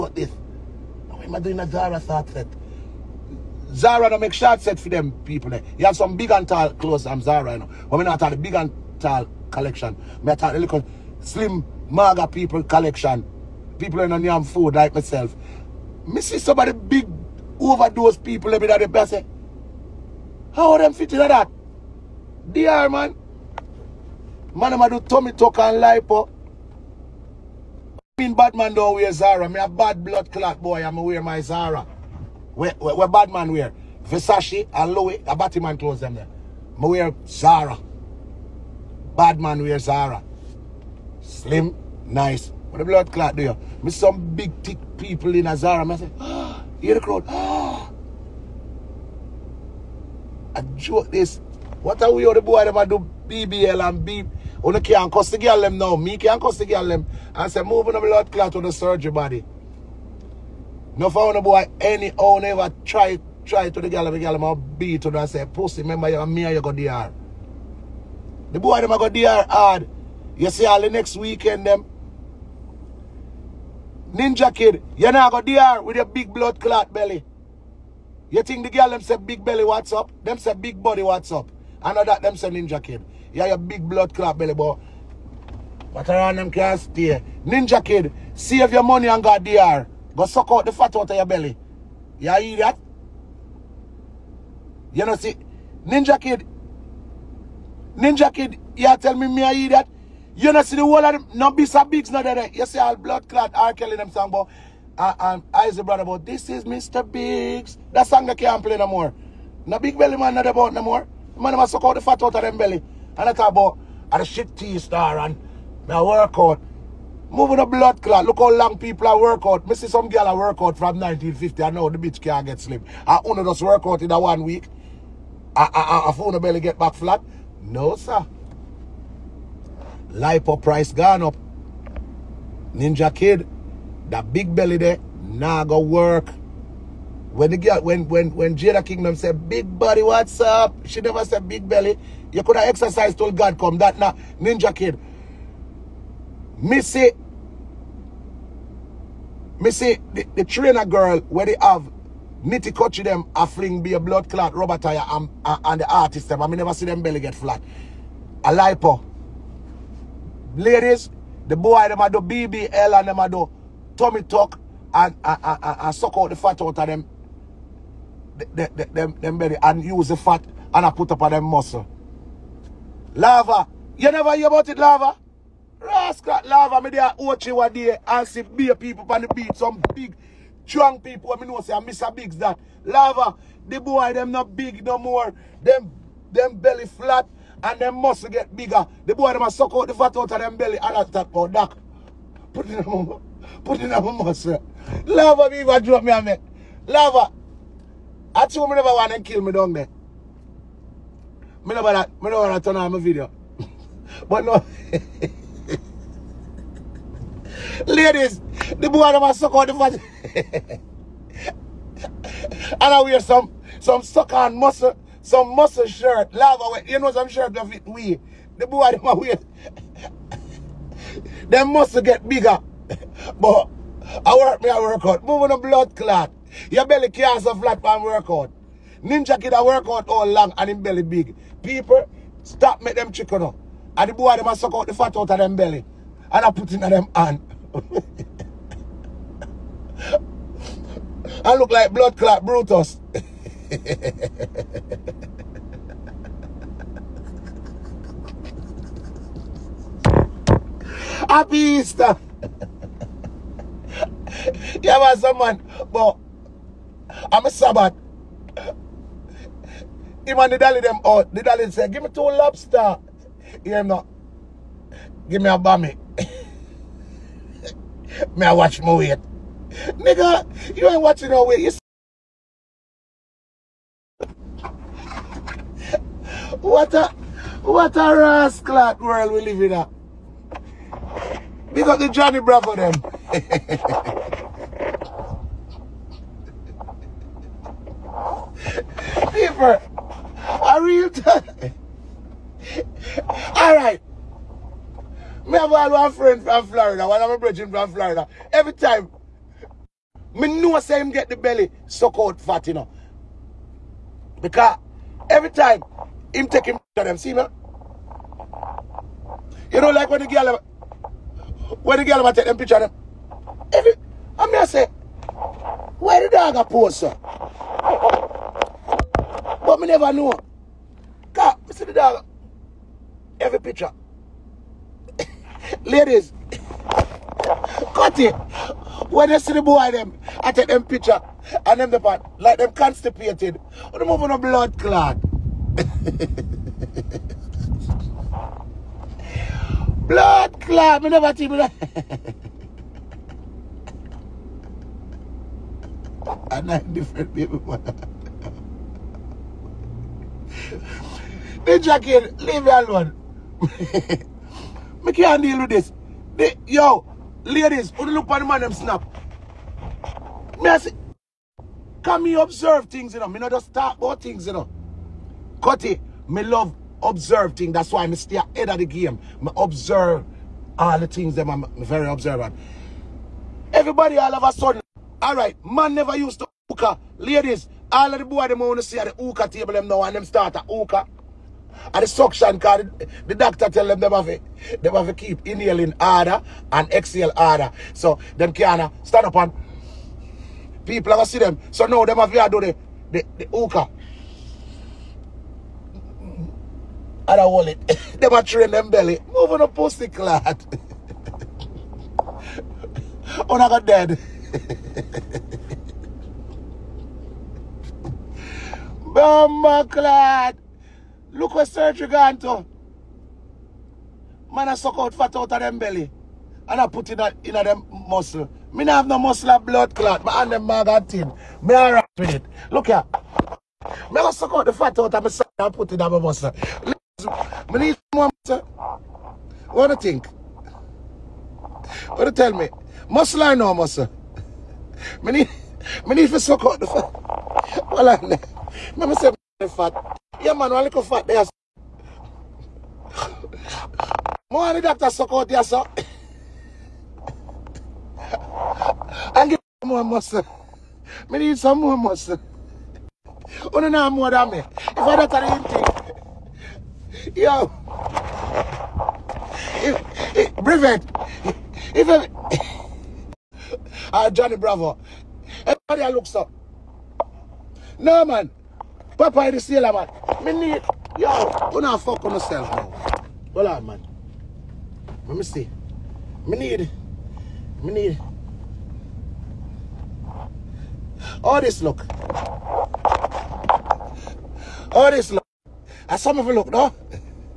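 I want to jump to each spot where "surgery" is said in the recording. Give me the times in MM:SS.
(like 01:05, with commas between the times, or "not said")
00:58, 06:51.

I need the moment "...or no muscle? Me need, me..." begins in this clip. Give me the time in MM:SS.
07:13.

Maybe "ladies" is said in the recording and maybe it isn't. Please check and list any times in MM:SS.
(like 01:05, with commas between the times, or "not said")
02:40, 03:27, 05:25, 05:57, 06:17.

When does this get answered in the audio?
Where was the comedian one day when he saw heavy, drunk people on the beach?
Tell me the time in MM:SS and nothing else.
02:57.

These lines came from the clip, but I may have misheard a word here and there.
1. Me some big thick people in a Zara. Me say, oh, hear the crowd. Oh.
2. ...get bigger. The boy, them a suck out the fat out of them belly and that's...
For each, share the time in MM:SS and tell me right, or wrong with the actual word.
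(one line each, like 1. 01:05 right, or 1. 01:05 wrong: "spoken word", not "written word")
1. 00:43 right
2. 03:08 right.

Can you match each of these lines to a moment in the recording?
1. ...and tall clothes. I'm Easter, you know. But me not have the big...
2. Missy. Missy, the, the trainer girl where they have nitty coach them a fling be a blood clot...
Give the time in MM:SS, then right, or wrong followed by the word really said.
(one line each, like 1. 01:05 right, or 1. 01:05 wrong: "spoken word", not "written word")
1. 00:06 wrong: "Zara", not "Easter"
2. 02:26 right.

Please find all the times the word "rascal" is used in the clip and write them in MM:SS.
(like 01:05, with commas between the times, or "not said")
02:55, 04:38.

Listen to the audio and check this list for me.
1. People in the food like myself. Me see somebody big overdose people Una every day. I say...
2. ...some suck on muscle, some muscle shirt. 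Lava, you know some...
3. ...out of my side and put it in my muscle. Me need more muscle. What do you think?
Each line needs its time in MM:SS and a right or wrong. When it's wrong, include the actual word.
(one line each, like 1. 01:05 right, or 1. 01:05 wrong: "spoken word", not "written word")
1. 00:13 wrong: "Let", not "Una"
2. 03:33 right
3. 07:04 right.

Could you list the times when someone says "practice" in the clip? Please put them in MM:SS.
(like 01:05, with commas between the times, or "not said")
not said.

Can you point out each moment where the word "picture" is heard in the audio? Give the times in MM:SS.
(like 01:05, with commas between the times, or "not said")
05:12, 05:23, 05:30.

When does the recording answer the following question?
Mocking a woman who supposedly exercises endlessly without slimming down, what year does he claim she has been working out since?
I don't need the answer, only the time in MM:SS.
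02:01.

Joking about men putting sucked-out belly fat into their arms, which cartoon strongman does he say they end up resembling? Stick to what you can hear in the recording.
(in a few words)
Brutus.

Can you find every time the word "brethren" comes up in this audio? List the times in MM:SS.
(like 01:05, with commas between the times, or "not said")
04:57.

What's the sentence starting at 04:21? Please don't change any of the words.
Oh, the dolly said, give me two lobster.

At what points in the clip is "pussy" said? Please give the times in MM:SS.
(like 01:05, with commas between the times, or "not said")
01:05, 06:39.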